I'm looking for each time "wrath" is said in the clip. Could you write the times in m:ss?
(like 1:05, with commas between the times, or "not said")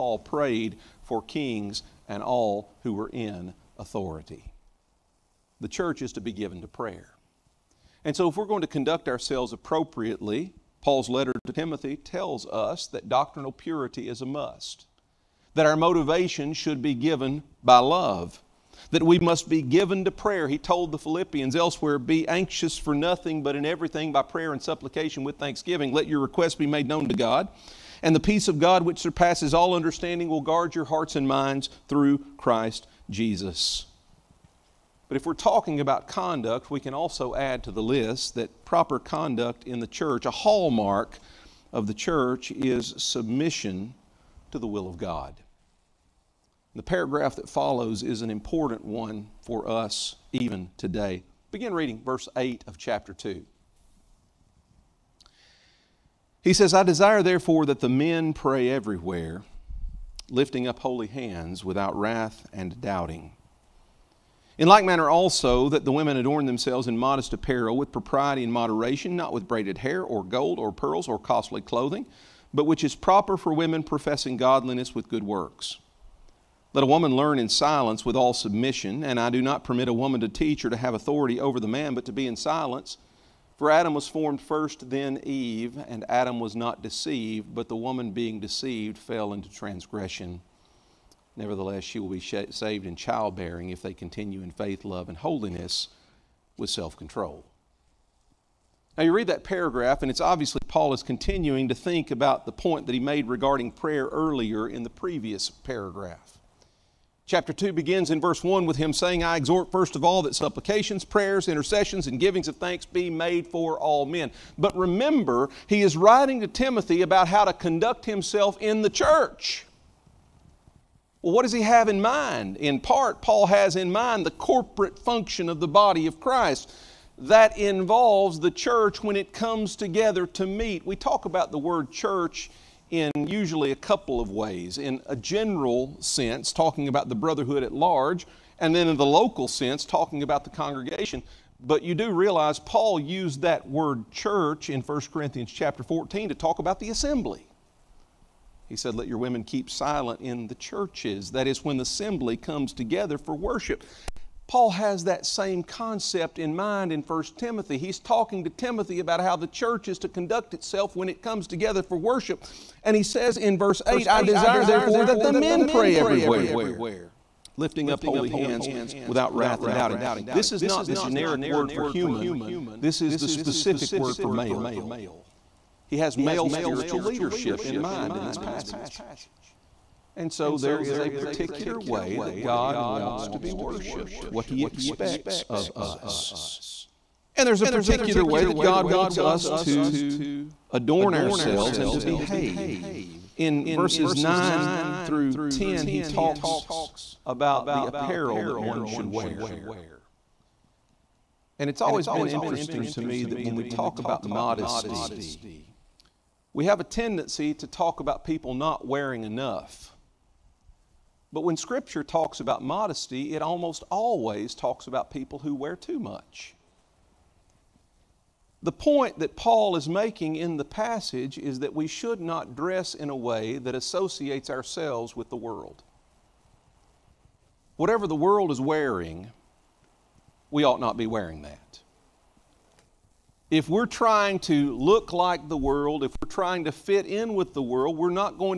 1:01, 2:49.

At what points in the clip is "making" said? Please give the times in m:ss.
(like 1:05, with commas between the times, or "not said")
3:39.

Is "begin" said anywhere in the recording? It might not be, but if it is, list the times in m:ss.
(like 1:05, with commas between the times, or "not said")
0:51, 1:47.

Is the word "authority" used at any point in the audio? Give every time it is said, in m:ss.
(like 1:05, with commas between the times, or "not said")
0:03, 1:20.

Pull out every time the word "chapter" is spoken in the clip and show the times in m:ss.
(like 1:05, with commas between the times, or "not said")
0:52, 1:47, 2:25.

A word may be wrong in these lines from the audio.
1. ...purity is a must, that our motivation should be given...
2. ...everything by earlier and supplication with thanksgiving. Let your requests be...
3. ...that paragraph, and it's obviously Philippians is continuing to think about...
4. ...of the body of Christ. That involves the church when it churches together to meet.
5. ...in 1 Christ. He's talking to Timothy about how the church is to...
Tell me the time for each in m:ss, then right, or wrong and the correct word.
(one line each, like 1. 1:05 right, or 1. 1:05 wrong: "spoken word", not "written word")
1. 0:13 right
2. 0:23 wrong: "prayer", not "earlier"
3. 1:39 wrong: "Paul", not "Philippians"
4. 2:05 wrong: "comes", not "churches"
5. 2:36 wrong: "Timothy", not "Christ".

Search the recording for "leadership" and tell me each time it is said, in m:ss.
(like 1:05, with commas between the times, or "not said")
2:57.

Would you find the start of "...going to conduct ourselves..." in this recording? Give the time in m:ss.
0:08.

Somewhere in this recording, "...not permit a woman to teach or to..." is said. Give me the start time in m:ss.
1:19.